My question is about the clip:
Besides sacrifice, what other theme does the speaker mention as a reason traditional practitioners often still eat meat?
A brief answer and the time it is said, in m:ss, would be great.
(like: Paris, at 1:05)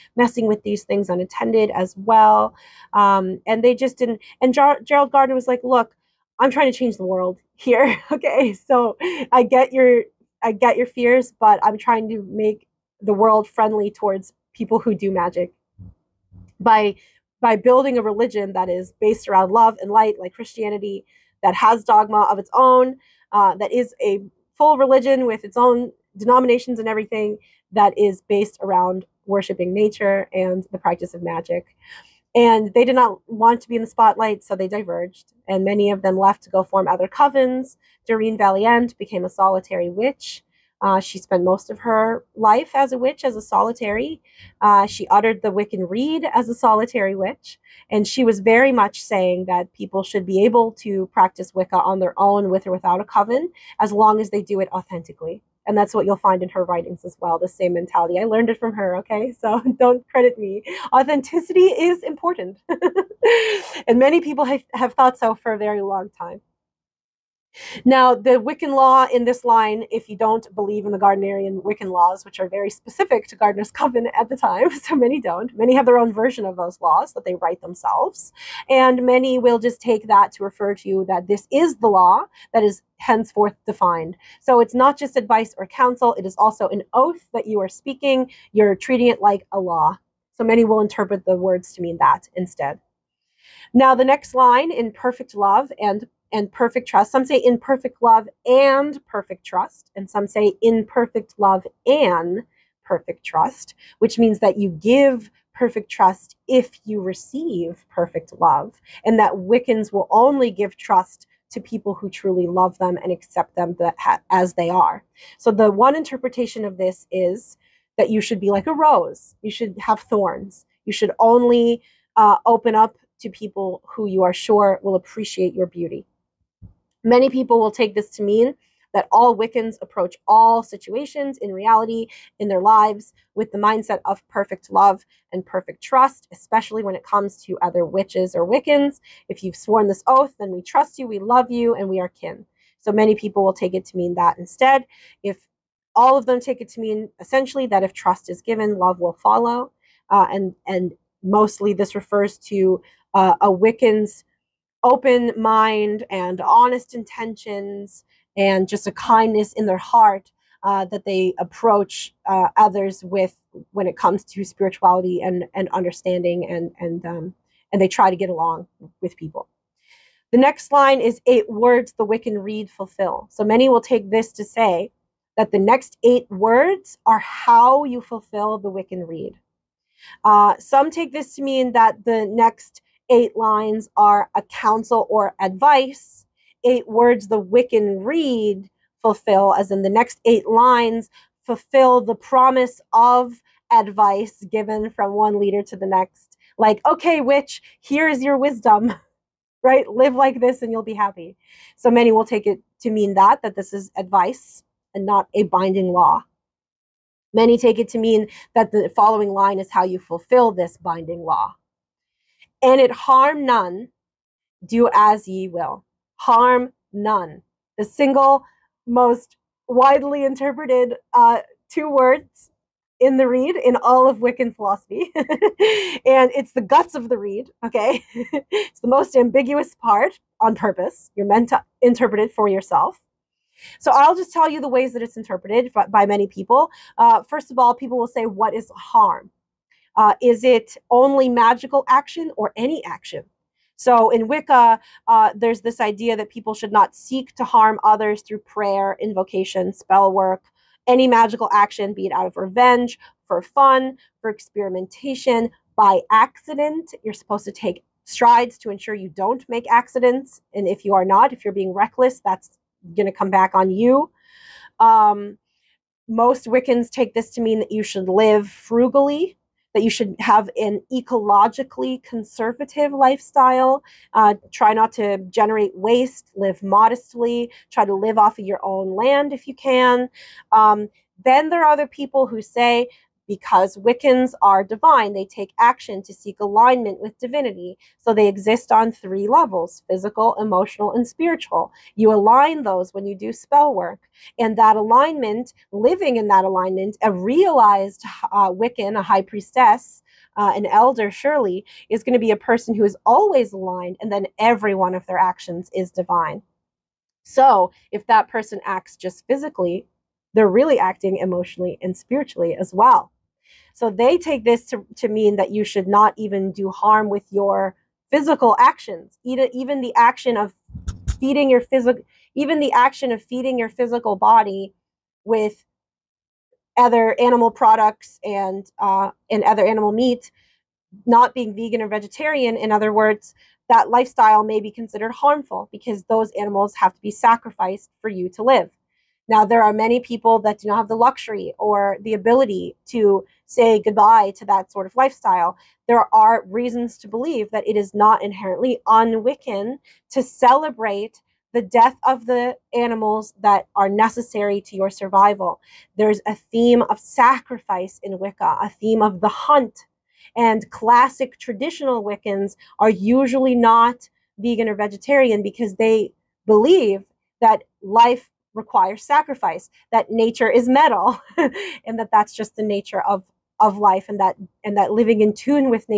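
the hunt, at 5:59.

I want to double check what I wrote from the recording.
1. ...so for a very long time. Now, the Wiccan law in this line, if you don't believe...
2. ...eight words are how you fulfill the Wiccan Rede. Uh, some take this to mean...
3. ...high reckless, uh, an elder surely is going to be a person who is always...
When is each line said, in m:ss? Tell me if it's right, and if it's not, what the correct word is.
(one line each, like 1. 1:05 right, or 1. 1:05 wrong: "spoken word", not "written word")
1. 1:05 right
2. 2:56 right
3. 4:59 wrong: "priestess", not "reckless".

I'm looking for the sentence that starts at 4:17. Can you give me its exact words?
You're supposed to take strides to ensure you don't make accidents.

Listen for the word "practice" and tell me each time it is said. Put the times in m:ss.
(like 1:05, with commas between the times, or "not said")
0:30, 0:51.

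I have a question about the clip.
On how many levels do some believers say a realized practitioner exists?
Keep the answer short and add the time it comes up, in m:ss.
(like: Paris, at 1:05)
3, at 4:48.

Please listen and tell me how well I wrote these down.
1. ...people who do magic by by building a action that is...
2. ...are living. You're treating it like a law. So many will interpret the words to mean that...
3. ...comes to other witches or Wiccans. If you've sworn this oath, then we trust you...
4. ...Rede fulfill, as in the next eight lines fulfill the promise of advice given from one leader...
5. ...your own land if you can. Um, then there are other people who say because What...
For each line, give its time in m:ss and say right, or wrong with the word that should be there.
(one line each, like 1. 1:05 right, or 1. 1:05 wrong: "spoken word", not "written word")
1. 0:14 wrong: "religion", not "action"
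2. 1:27 wrong: "speaking", not "living"
3. 2:17 right
4. 3:08 right
5. 4:38 wrong: "Wiccans", not "What".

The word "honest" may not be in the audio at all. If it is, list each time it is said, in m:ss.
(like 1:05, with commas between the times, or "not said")
2:36.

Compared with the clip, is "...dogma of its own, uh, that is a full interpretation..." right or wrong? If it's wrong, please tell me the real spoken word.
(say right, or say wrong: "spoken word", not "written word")
wrong: "religion", not "interpretation".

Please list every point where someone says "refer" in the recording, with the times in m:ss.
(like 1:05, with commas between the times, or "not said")
1:20, 2:31.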